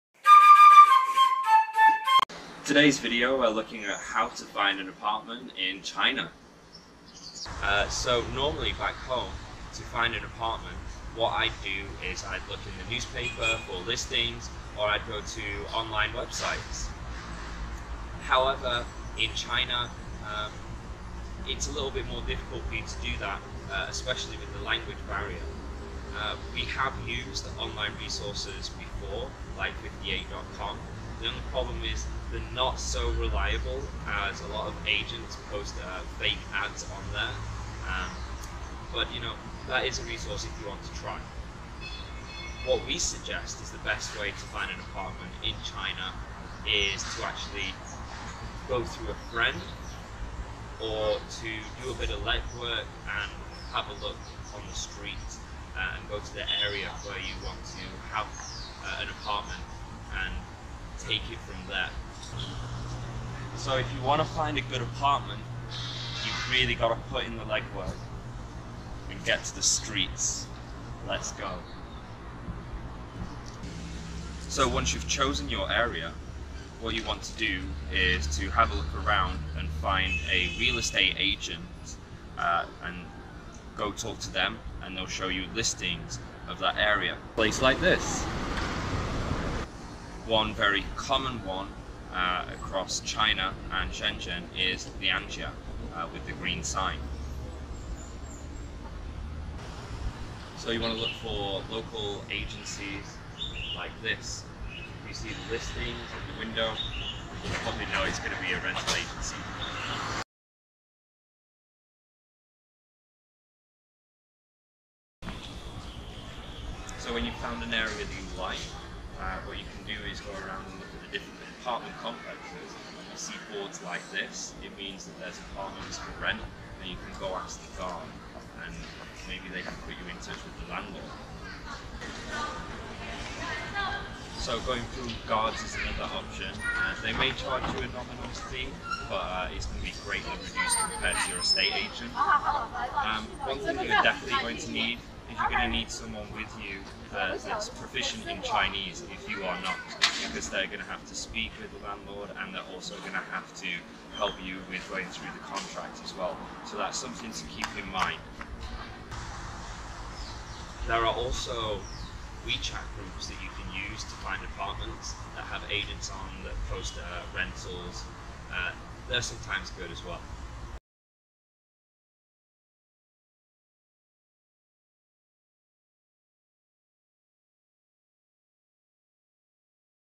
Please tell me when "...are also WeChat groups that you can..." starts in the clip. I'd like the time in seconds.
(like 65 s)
161 s.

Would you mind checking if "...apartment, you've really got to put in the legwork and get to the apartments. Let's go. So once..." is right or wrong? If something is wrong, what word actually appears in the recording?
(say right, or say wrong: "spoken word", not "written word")
wrong: "streets", not "apartments".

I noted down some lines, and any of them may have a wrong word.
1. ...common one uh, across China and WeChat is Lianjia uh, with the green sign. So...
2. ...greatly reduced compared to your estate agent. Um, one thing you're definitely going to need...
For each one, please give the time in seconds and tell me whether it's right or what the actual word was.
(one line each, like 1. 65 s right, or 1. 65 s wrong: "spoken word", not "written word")
1. 90 s wrong: "Shenzhen", not "WeChat"
2. 140 s right.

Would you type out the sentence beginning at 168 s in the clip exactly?
Uh, they're sometimes good as well.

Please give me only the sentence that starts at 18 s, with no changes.
However in China um, it's a little bit more difficult for you to do that uh, especially with the language barrier.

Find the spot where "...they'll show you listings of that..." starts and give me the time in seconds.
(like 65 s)
84 s.